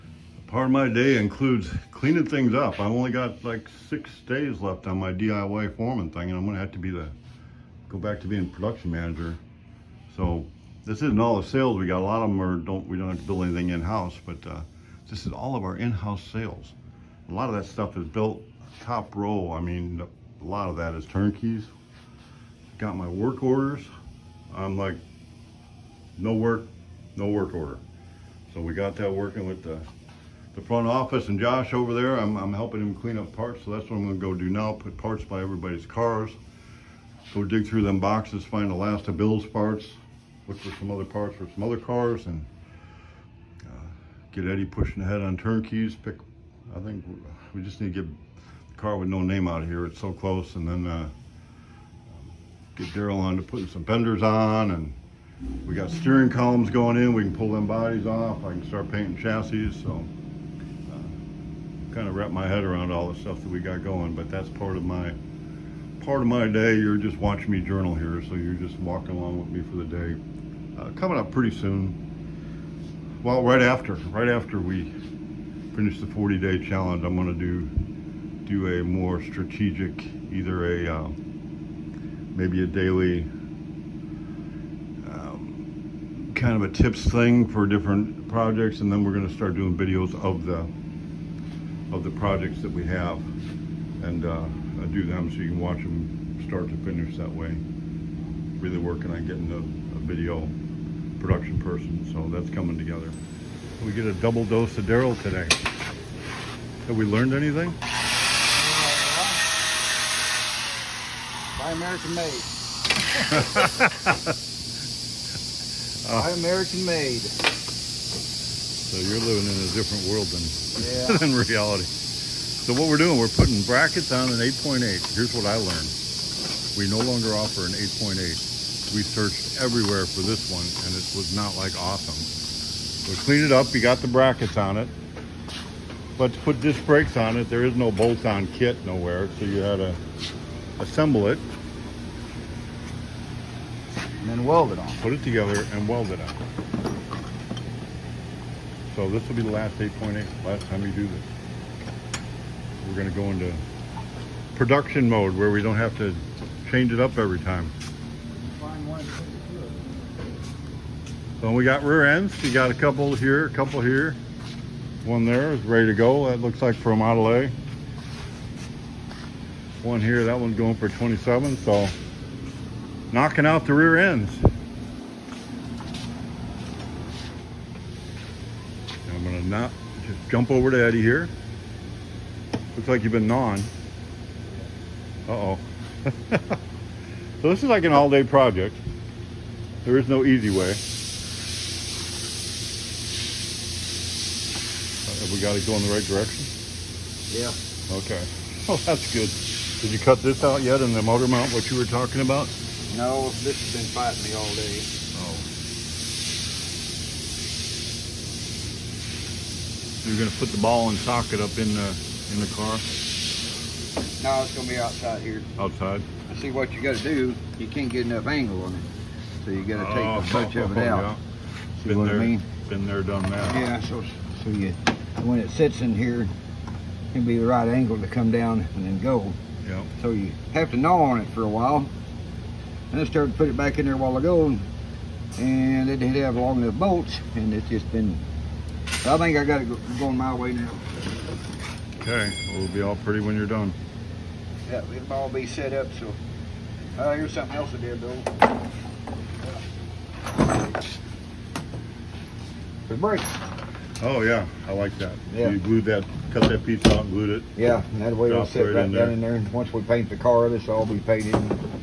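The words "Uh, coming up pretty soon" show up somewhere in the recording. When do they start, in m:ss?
1:10.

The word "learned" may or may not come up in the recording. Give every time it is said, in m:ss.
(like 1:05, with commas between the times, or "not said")
1:47, 2:05.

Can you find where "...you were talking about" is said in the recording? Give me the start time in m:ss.
3:21.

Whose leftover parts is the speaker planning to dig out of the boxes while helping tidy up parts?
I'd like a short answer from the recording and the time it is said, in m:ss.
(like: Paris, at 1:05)
Bill's, at 0:39.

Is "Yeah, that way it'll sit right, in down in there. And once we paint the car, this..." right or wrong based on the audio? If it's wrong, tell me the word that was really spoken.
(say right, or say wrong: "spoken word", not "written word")
right.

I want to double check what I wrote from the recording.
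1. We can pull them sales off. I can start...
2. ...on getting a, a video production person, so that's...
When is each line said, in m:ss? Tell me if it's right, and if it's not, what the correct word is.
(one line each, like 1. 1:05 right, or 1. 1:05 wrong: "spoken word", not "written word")
1. 0:57 wrong: "bodies", not "sales"
2. 1:39 right.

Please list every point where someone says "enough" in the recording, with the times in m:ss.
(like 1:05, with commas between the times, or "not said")
3:38, 3:56.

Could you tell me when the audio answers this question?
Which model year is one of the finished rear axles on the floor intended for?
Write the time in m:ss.
2:50.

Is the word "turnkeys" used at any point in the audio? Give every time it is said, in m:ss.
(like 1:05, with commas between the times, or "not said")
0:21, 0:45.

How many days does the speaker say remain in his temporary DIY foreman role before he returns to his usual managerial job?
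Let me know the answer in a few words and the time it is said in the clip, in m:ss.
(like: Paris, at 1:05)
6, at 0:03.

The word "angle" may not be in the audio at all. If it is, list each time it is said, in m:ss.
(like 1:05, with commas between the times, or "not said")
3:38, 3:47.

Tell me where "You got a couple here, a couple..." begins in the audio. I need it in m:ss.
2:42.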